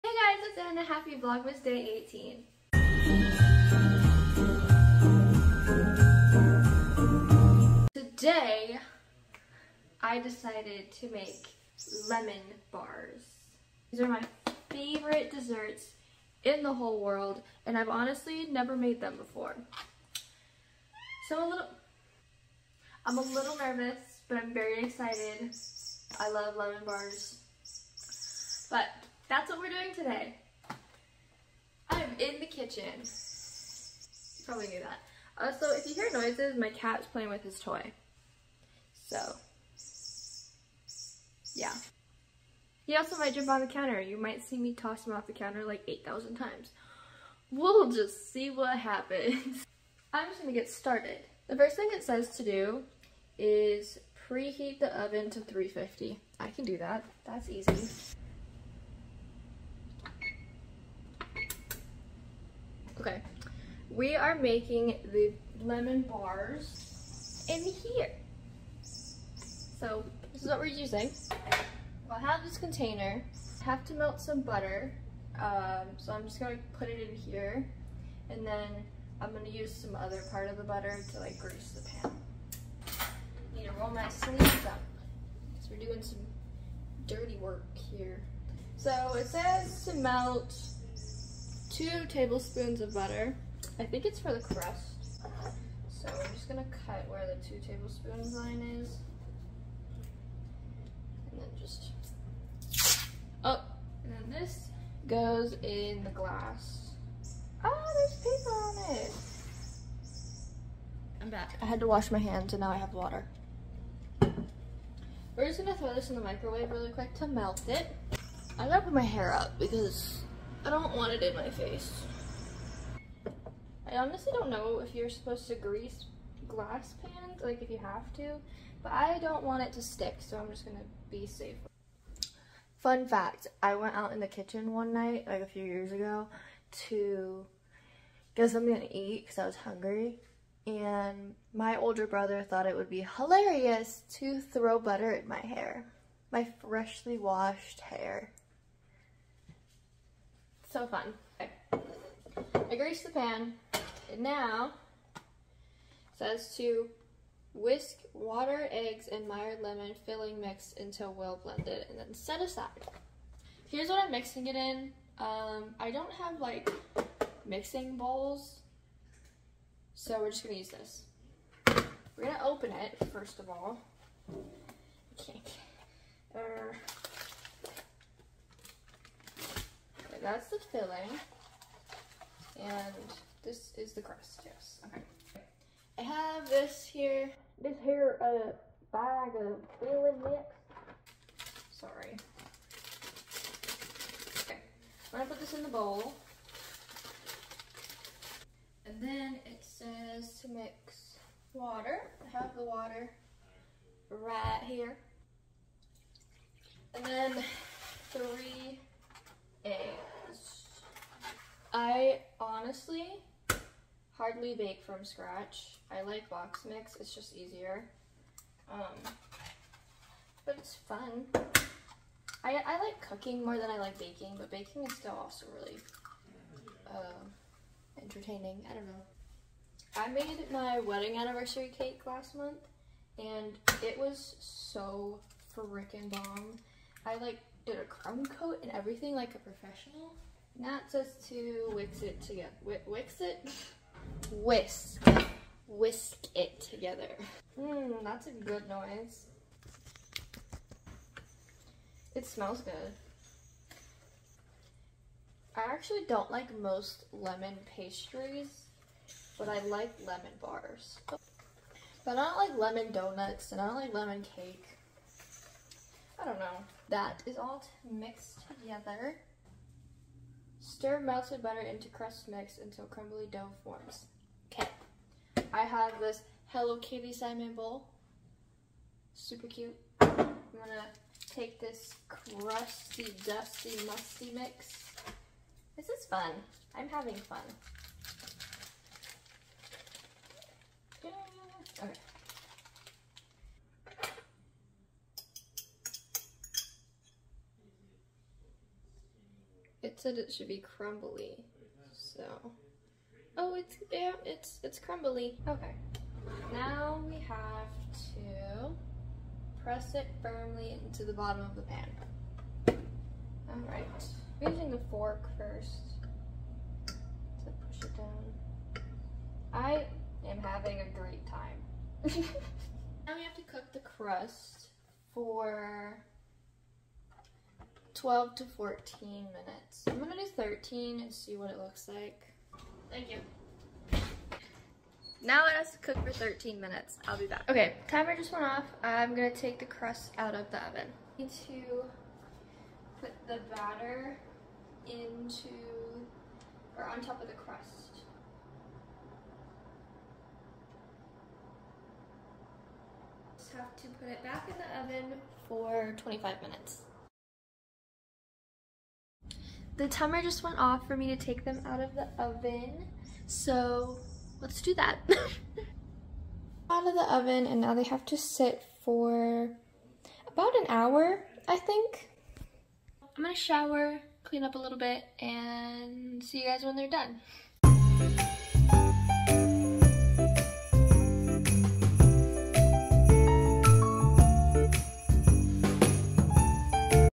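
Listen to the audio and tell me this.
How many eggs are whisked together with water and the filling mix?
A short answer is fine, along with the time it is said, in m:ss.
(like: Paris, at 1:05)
3, at 3:28.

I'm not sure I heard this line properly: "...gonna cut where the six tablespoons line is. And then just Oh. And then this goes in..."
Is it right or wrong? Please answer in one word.
wrong.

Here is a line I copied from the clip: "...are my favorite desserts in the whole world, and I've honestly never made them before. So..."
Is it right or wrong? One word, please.
right.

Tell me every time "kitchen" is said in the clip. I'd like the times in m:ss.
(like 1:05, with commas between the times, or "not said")
0:32, 2:14.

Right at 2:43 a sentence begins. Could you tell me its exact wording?
Here's what I'm mixing it in.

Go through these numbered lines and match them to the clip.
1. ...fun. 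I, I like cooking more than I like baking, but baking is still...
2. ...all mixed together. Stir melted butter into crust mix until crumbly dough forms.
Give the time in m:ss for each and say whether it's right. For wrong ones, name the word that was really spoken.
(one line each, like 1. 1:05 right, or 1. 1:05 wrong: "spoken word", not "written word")
1. 3:40 right
2. 4:27 right.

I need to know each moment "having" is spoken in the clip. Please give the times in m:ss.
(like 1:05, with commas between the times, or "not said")
4:46, 5:20.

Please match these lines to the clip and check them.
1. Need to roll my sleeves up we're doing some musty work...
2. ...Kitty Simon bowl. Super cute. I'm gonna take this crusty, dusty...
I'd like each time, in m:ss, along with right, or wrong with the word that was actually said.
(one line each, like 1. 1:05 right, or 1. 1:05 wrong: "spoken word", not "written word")
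1. 1:23 wrong: "dirty", not "musty"
2. 4:36 right.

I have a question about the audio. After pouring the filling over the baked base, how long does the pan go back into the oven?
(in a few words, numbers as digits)
25 minutes.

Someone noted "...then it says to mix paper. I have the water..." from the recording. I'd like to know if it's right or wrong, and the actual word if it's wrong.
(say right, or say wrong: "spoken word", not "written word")
wrong: "water", not "paper".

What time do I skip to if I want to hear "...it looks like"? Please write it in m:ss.
5:31.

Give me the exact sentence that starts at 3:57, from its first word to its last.
I like did a crumb coat and everything like a professional.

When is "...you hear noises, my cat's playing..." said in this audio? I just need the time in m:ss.
0:35.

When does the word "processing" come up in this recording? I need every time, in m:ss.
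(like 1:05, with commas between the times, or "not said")
not said.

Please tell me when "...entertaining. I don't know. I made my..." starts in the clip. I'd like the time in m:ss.
3:47.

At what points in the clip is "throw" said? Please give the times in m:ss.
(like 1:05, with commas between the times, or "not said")
1:55, 2:24.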